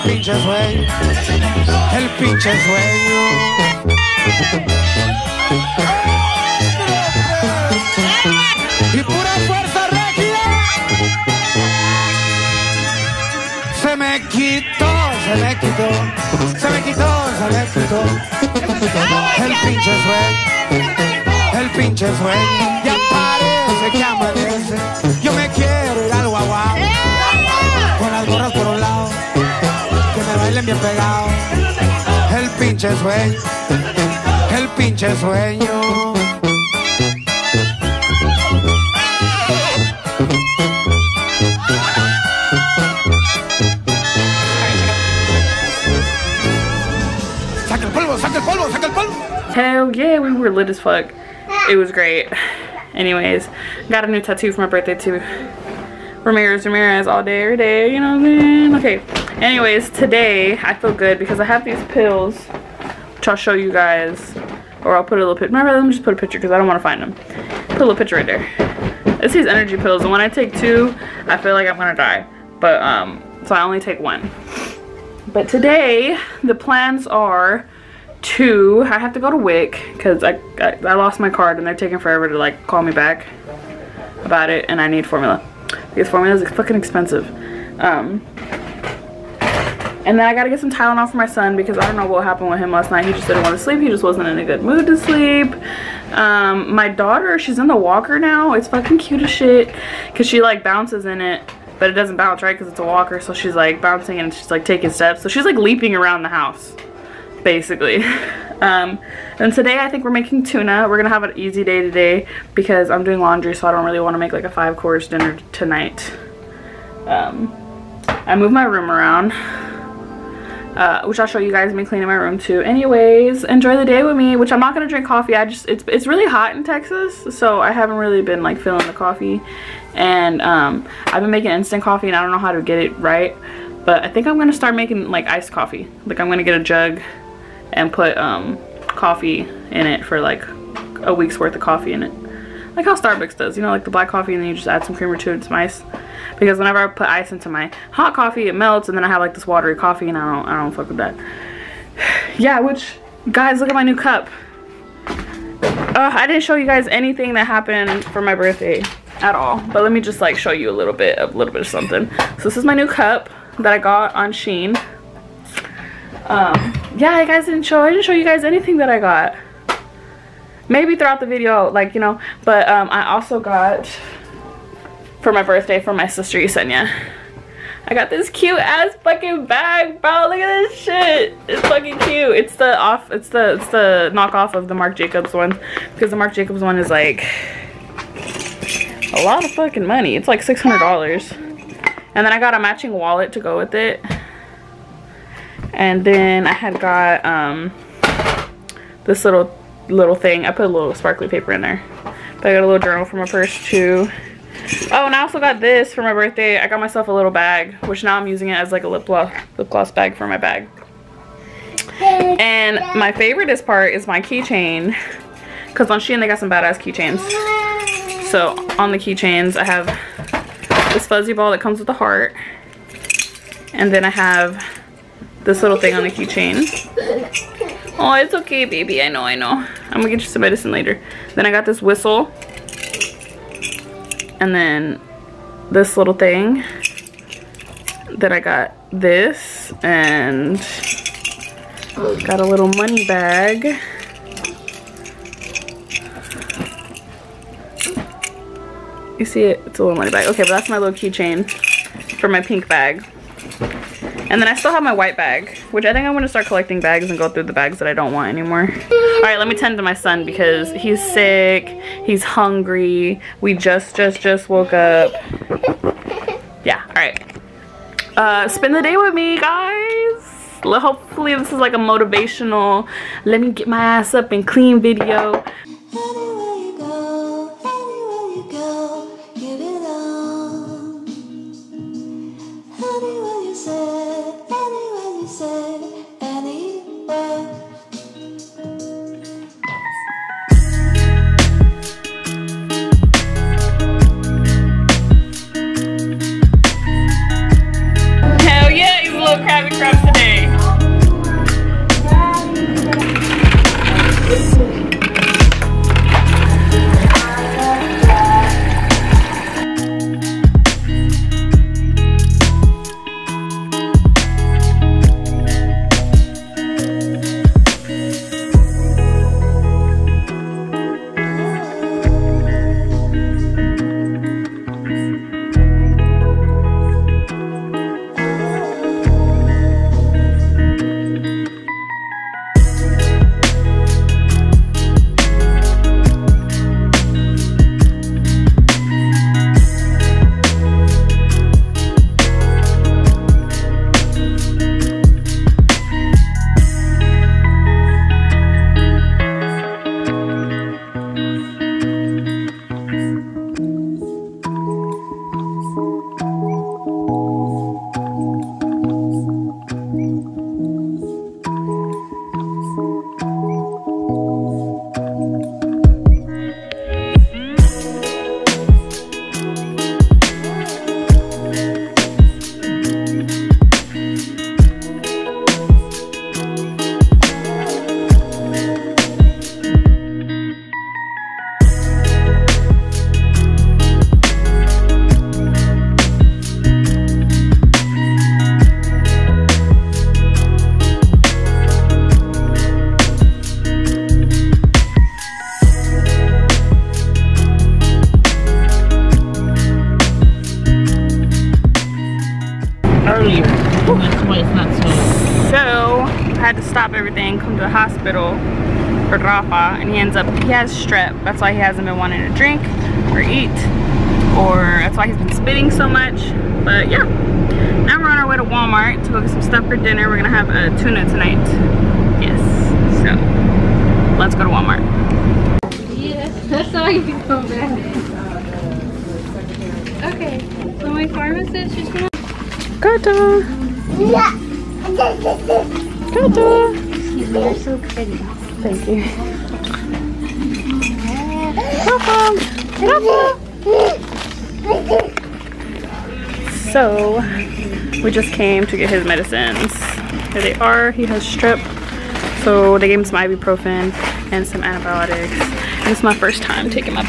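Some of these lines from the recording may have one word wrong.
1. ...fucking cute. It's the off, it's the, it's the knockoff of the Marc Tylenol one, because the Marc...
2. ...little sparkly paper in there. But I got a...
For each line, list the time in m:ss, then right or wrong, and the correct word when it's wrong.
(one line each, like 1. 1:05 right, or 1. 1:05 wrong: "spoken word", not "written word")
1. 3:01 wrong: "Jacobs", not "Tylenol"
2. 3:20 right.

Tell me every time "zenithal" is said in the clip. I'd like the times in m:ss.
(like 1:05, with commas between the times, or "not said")
not said.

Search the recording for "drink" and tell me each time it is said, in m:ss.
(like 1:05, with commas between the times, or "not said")
2:04, 6:52.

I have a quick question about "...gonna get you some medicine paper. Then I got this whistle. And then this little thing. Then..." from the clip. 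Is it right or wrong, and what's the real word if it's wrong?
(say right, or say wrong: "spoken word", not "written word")
wrong: "later", not "paper".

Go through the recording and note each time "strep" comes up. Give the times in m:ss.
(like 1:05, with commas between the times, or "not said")
6:50, 7:31.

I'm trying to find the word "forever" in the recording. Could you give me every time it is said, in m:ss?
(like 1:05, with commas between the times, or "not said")
1:21.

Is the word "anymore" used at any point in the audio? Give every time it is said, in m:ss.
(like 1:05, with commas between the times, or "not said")
4:18.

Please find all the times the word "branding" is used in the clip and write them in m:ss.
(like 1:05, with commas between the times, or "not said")
not said.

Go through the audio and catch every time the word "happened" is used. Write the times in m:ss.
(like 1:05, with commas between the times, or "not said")
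1:32, 2:37.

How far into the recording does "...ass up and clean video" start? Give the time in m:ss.
4:33.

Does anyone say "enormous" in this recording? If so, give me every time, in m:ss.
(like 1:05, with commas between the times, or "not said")
not said.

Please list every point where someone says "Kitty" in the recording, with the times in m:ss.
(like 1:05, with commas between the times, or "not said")
not said.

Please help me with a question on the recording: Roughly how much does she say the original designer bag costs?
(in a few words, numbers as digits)
$600.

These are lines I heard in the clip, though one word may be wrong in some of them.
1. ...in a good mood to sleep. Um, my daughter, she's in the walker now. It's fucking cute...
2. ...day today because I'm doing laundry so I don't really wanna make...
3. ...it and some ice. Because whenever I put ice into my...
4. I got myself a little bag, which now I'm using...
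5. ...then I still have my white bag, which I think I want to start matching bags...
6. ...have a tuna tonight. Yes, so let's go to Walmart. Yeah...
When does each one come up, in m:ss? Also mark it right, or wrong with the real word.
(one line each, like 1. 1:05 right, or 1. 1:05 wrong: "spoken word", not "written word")
1. 1:34 right
2. 1:51 right
3. 2:25 right
4. 3:26 right
5. 4:14 wrong: "collecting", not "matching"
6. 7:00 right.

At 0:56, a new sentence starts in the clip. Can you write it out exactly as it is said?
Ramirez, Ramirez all day, every day, you know what I mean?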